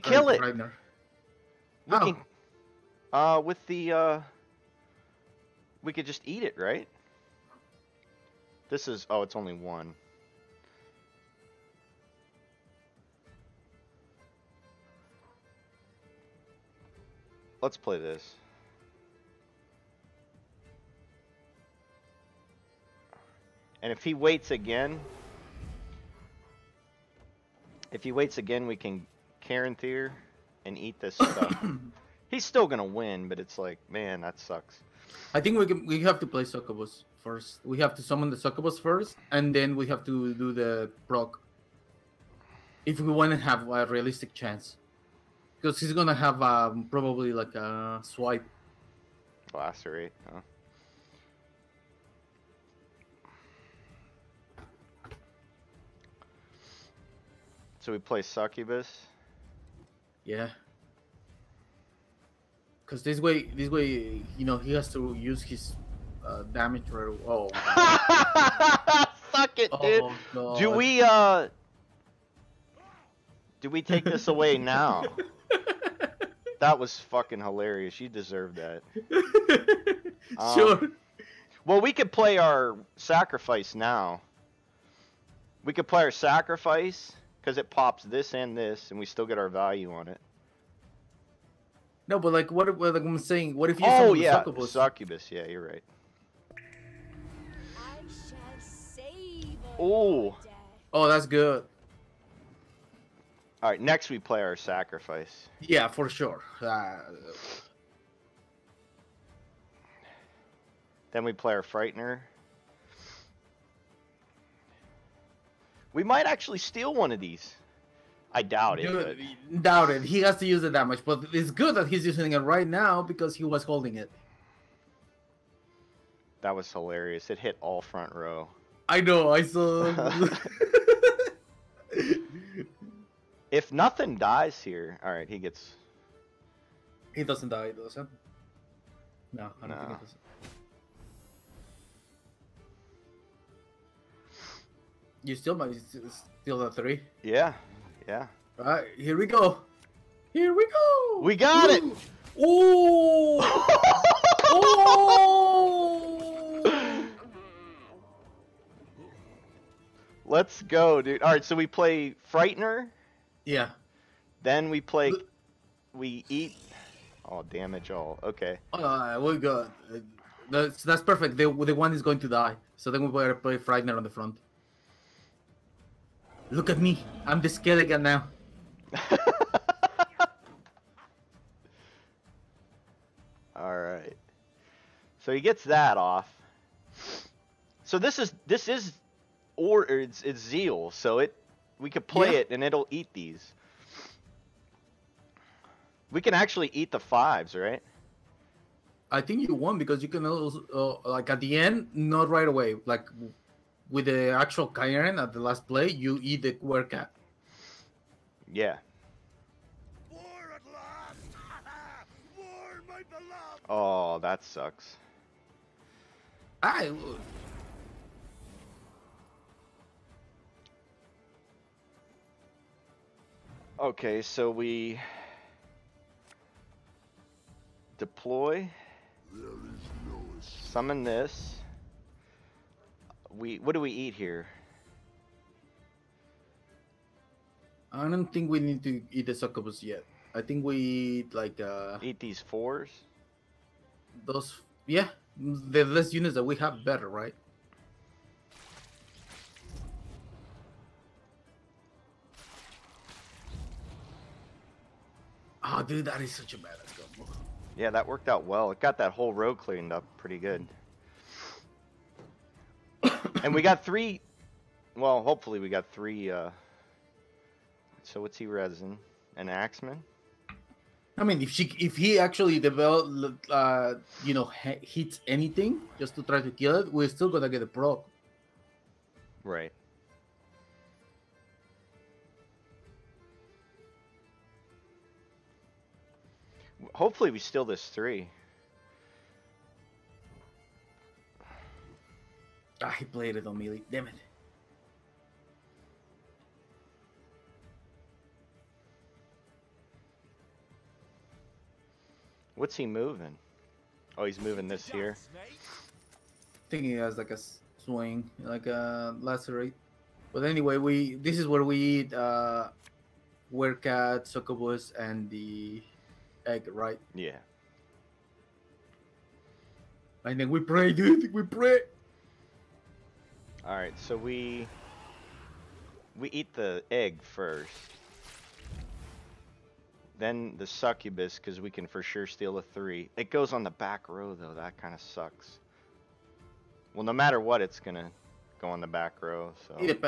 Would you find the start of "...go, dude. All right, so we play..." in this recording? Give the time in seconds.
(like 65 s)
160 s.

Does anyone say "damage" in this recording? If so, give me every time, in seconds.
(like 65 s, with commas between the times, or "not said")
66 s, 167 s.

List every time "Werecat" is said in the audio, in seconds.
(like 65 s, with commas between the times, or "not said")
206 s, 313 s.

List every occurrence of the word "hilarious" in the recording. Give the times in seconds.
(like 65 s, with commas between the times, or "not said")
77 s, 126 s.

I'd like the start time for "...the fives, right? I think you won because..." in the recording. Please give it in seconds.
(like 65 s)
196 s.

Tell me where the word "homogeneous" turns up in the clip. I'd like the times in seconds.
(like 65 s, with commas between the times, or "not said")
not said.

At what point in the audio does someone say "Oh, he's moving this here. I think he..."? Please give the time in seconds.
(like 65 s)
304 s.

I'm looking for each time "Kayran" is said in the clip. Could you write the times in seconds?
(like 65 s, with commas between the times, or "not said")
204 s.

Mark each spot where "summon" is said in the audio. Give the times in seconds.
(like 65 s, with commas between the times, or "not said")
38 s, 230 s.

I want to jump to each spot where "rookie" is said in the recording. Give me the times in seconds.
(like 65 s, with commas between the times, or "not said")
not said.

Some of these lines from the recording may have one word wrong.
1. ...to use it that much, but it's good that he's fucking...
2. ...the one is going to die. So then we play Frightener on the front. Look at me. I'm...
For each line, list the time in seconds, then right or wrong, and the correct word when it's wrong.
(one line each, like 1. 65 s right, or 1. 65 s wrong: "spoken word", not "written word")
1. 120 s wrong: "using", not "fucking"
2. 171 s right.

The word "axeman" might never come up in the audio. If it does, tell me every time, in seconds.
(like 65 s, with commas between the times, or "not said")
269 s.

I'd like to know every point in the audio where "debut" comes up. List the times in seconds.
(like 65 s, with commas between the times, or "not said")
not said.